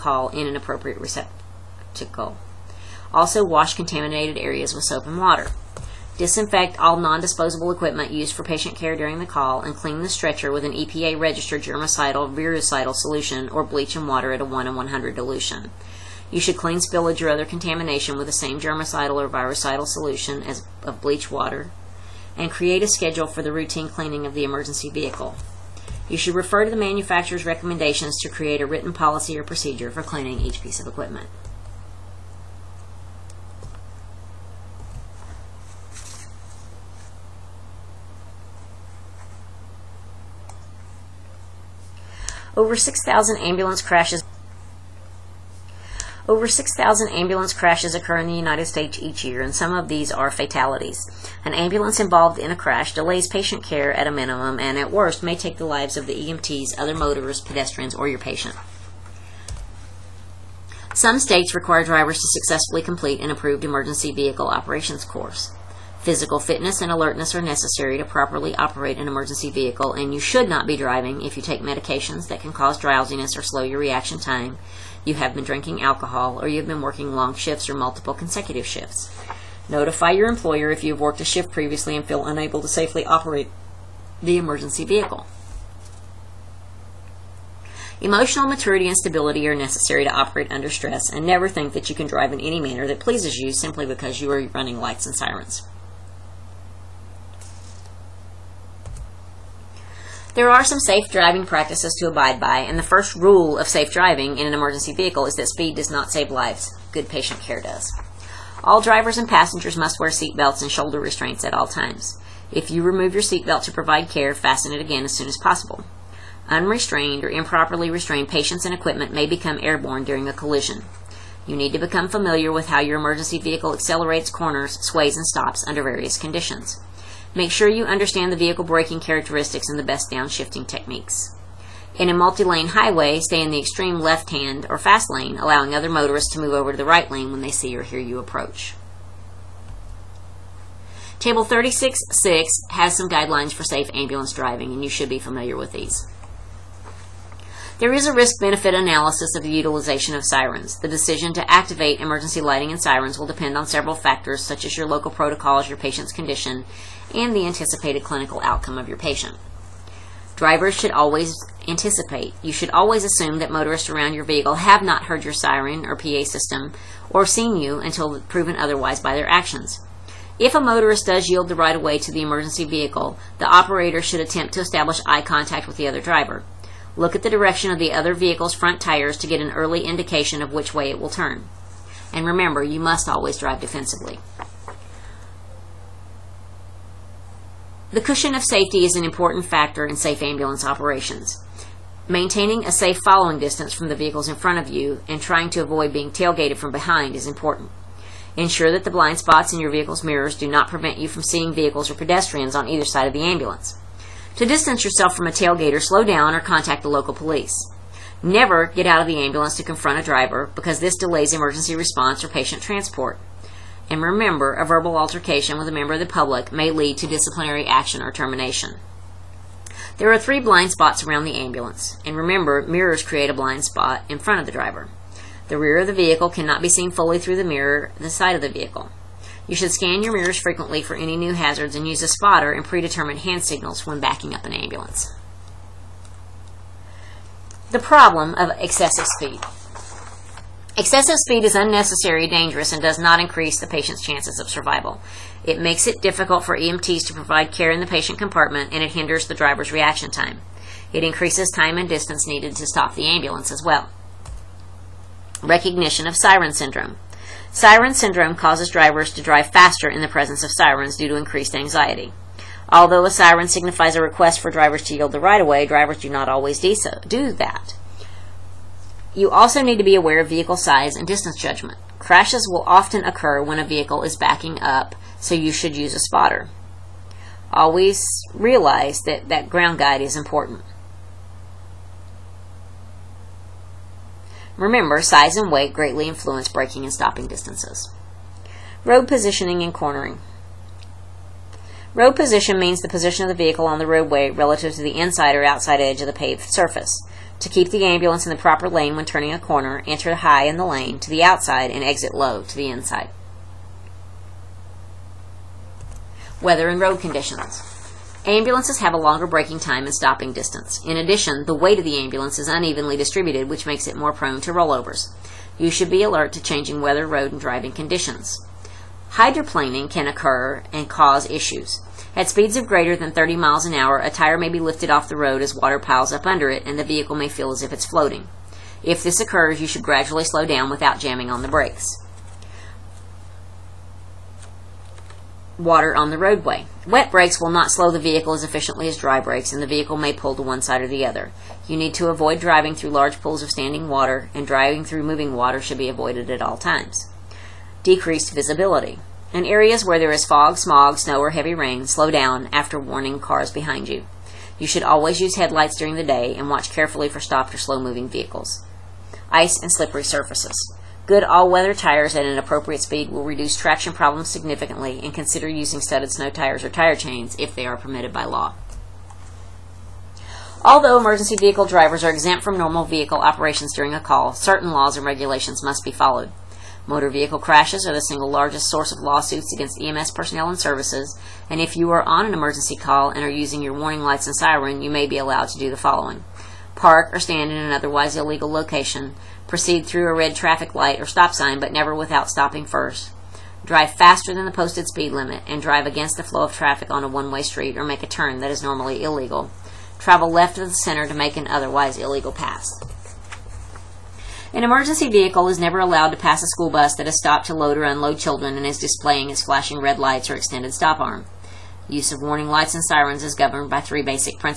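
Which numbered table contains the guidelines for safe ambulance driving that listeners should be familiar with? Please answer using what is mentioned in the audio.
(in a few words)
Table 36.6.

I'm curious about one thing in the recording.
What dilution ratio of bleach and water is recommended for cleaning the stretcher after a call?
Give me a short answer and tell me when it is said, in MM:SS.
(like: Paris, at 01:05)
1 in 100, at 00:14.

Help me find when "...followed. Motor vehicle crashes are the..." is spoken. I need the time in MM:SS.
06:15.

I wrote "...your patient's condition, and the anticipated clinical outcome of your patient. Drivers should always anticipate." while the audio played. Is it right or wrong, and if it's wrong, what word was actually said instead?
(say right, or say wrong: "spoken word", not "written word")
right.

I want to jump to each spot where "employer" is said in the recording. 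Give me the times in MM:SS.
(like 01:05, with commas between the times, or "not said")
01:20.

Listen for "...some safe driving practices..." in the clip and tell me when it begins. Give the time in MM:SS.
01:40.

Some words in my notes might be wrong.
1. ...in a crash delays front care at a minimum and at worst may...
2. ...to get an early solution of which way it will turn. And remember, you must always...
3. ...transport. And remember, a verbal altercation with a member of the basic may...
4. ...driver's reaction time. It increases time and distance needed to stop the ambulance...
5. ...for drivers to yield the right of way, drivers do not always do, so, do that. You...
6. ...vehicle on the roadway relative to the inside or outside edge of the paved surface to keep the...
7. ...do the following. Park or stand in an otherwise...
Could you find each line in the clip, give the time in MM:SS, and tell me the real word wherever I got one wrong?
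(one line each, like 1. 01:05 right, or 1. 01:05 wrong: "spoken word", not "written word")
1. 00:52 wrong: "patient", not "front"
2. 02:59 wrong: "indication", not "solution"
3. 03:32 wrong: "public", not "basic"
4. 04:09 right
5. 04:24 right
6. 04:53 right
7. 06:25 right.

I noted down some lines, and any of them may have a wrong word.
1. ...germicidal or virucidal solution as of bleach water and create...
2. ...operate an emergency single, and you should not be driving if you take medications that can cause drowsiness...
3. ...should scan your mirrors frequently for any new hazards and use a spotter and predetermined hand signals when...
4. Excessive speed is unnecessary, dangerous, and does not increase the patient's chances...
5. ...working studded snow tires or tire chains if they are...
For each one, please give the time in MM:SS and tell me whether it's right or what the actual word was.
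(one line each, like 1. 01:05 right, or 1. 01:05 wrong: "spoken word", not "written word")
1. 00:18 right
2. 01:08 wrong: "vehicle", not "single"
3. 03:49 right
4. 04:00 right
5. 06:05 wrong: "using", not "working".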